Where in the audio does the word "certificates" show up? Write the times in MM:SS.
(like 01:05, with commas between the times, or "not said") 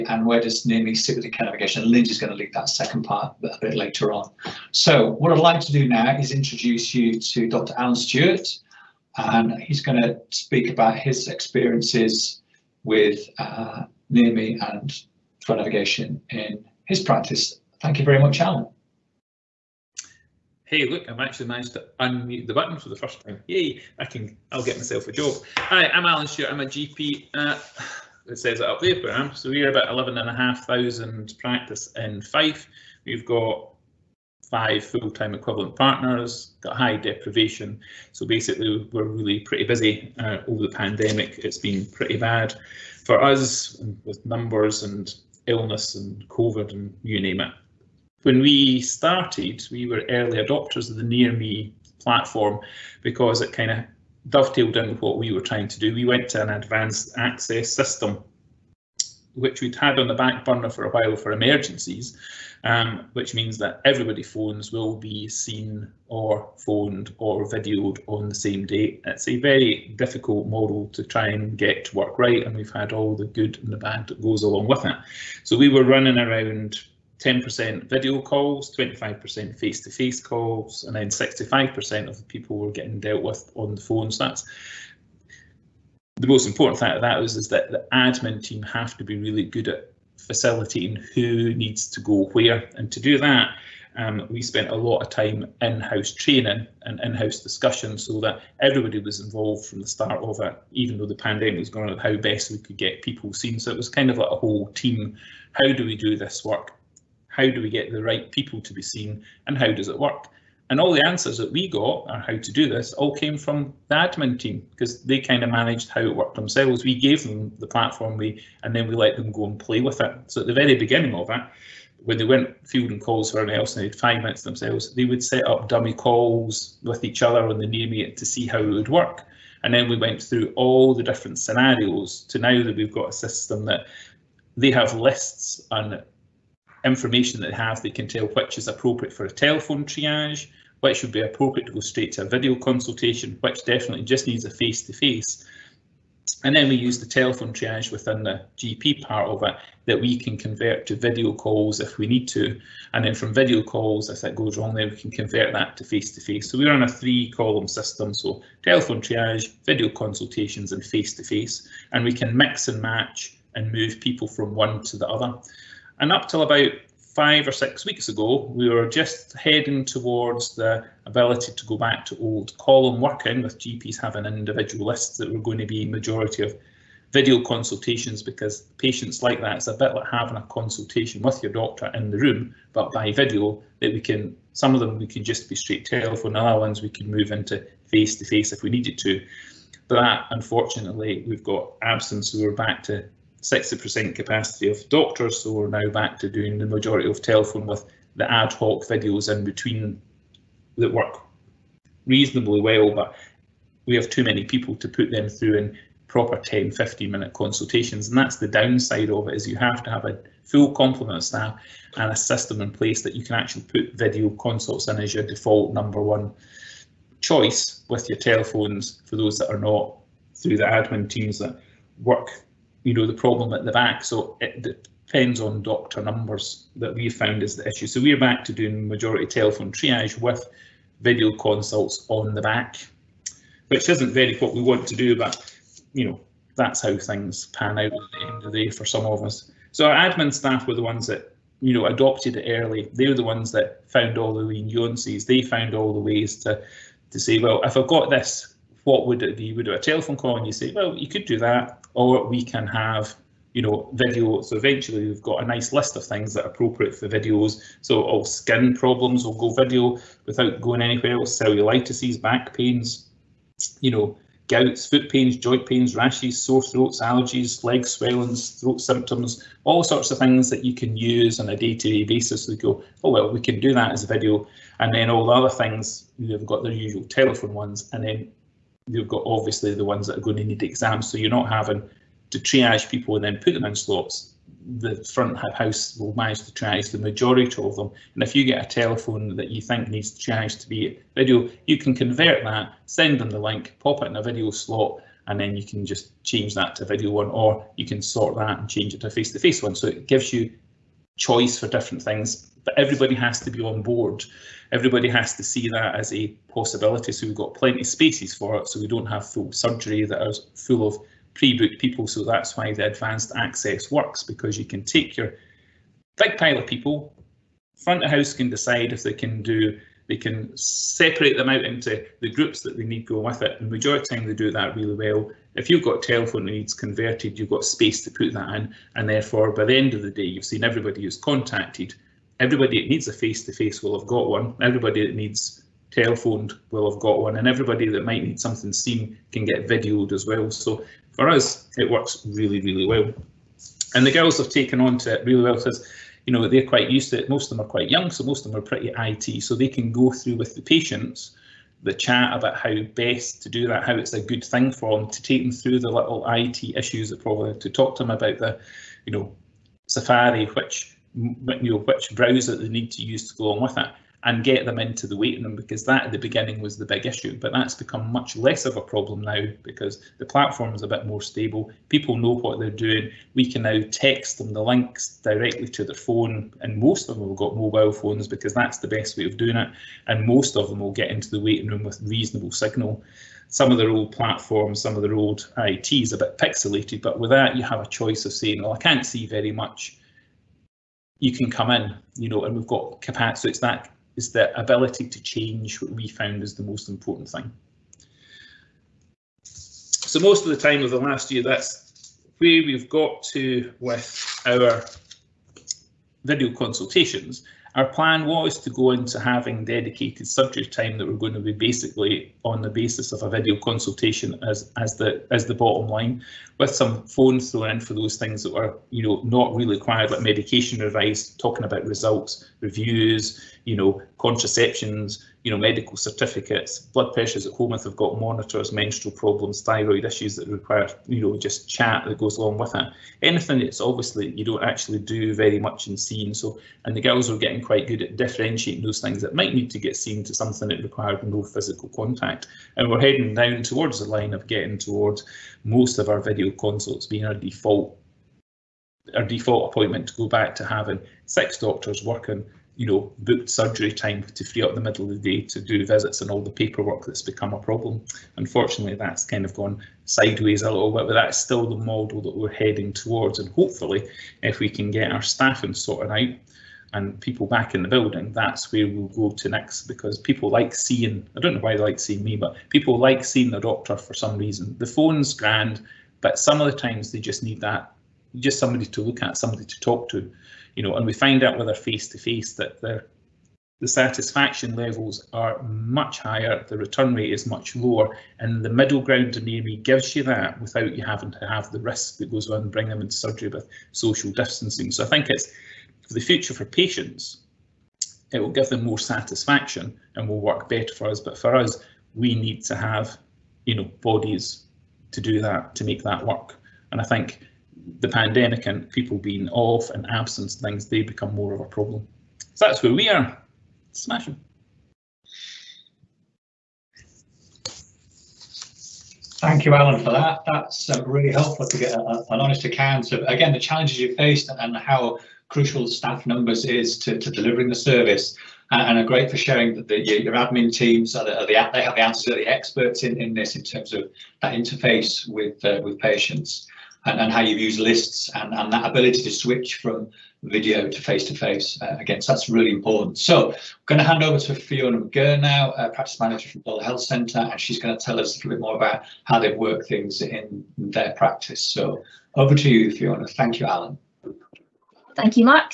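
07:05.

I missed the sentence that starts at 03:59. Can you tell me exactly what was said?
So our admin staff were the ones that you know adopted it early.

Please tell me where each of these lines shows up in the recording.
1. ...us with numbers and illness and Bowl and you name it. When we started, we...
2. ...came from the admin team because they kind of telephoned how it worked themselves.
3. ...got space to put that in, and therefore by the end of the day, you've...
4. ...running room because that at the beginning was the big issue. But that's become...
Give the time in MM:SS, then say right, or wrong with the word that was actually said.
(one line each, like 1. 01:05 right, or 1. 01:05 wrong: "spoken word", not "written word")
1. 00:43 wrong: "COVID", not "Bowl"
2. 01:53 wrong: "managed", not "telephoned"
3. 05:27 right
4. 06:05 wrong: "waiting", not "running".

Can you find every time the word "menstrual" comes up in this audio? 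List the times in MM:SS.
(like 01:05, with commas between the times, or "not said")
07:08.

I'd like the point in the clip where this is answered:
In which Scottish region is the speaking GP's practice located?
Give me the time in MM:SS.
00:32.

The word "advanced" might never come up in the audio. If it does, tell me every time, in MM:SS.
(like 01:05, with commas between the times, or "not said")
00:56, 05:12.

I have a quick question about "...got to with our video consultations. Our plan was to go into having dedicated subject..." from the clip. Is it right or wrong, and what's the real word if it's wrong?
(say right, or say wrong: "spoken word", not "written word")
right.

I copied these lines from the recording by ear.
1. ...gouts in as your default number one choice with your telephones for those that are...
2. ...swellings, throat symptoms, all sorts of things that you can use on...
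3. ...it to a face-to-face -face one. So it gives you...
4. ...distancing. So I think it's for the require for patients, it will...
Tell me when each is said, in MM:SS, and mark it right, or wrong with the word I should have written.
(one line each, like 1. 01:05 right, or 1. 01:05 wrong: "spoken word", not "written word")
1. 03:34 wrong: "consults", not "gouts"
2. 04:27 right
3. 04:58 right
4. 08:14 wrong: "future", not "require".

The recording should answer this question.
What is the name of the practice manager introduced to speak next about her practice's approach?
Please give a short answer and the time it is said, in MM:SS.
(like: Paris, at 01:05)
Fiona McGirr, at 09:04.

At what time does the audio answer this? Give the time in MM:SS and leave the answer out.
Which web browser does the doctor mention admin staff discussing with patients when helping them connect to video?
05:59.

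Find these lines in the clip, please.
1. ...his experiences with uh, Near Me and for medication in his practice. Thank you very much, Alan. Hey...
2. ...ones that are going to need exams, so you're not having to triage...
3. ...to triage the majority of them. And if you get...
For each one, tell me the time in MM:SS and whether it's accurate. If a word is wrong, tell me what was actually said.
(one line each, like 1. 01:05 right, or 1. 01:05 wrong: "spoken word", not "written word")
1. 00:10 wrong: "navigation", not "medication"
2. 04:39 right
3. 04:46 right.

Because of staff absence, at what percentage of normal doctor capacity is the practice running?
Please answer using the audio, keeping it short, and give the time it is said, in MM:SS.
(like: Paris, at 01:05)
60%, at 03:13.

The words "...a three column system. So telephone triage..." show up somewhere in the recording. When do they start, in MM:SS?
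02:36.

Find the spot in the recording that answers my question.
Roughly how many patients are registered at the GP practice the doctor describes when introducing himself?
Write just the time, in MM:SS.
00:29.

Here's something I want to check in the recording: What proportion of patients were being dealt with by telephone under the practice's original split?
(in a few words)
65%.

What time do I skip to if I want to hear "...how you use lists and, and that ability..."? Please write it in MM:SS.
08:57.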